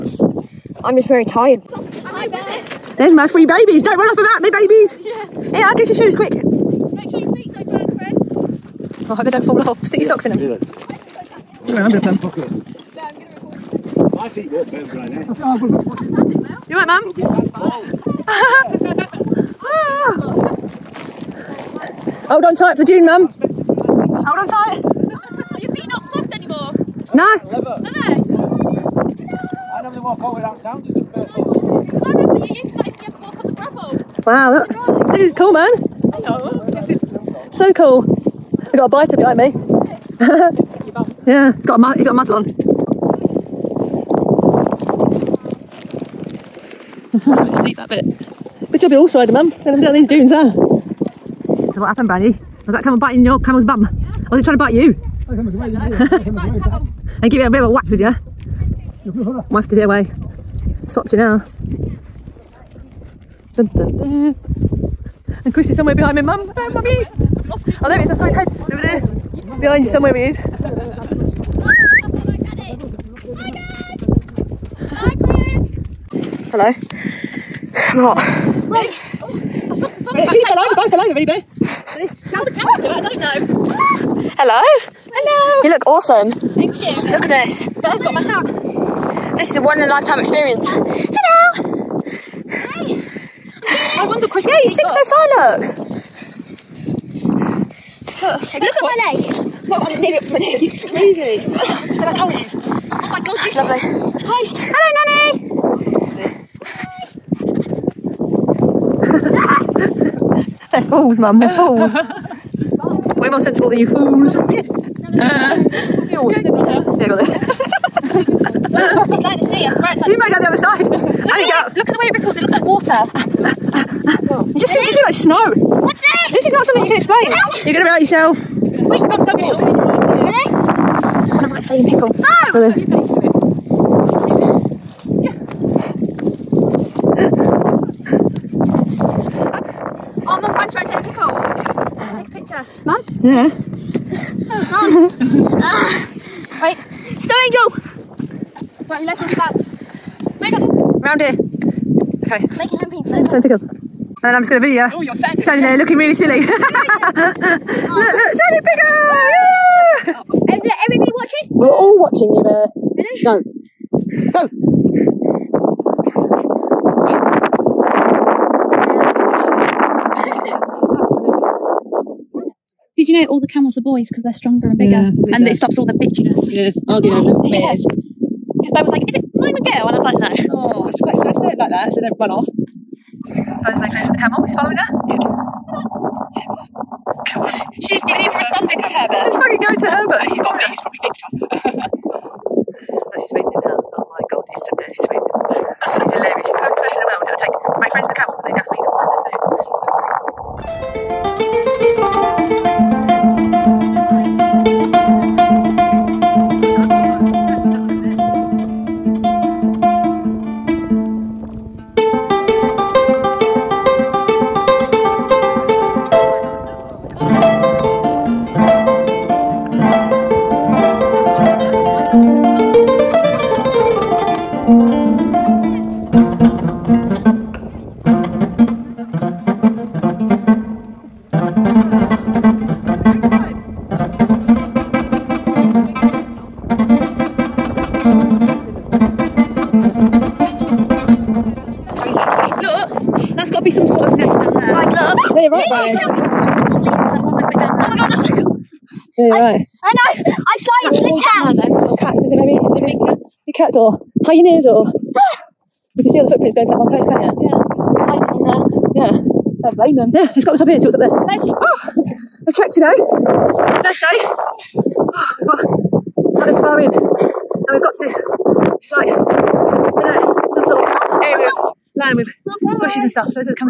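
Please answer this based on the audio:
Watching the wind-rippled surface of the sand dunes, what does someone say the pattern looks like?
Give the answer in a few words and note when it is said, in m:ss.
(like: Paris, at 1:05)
water, at 2:02.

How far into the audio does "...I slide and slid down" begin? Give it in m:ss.
4:10.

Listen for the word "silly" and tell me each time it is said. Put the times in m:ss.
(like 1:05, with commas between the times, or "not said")
2:36.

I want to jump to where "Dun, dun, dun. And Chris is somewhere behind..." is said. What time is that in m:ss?
1:03.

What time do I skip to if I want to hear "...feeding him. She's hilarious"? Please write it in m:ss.
3:15.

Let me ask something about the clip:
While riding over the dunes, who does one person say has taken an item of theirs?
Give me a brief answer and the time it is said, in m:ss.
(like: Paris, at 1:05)
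Bella, at 1:27.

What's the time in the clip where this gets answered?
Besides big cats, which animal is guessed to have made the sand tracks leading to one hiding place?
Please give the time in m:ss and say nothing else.
4:14.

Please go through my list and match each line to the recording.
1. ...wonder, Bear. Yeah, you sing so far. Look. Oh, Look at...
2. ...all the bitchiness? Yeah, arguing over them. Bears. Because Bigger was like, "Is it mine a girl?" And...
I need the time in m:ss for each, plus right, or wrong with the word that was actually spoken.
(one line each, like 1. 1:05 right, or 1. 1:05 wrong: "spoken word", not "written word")
1. 1:34 wrong: "Chris", not "Bear"
2. 2:55 wrong: "Bear", not "Bigger".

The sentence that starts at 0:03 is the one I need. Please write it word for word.
Don't run off about me, babies.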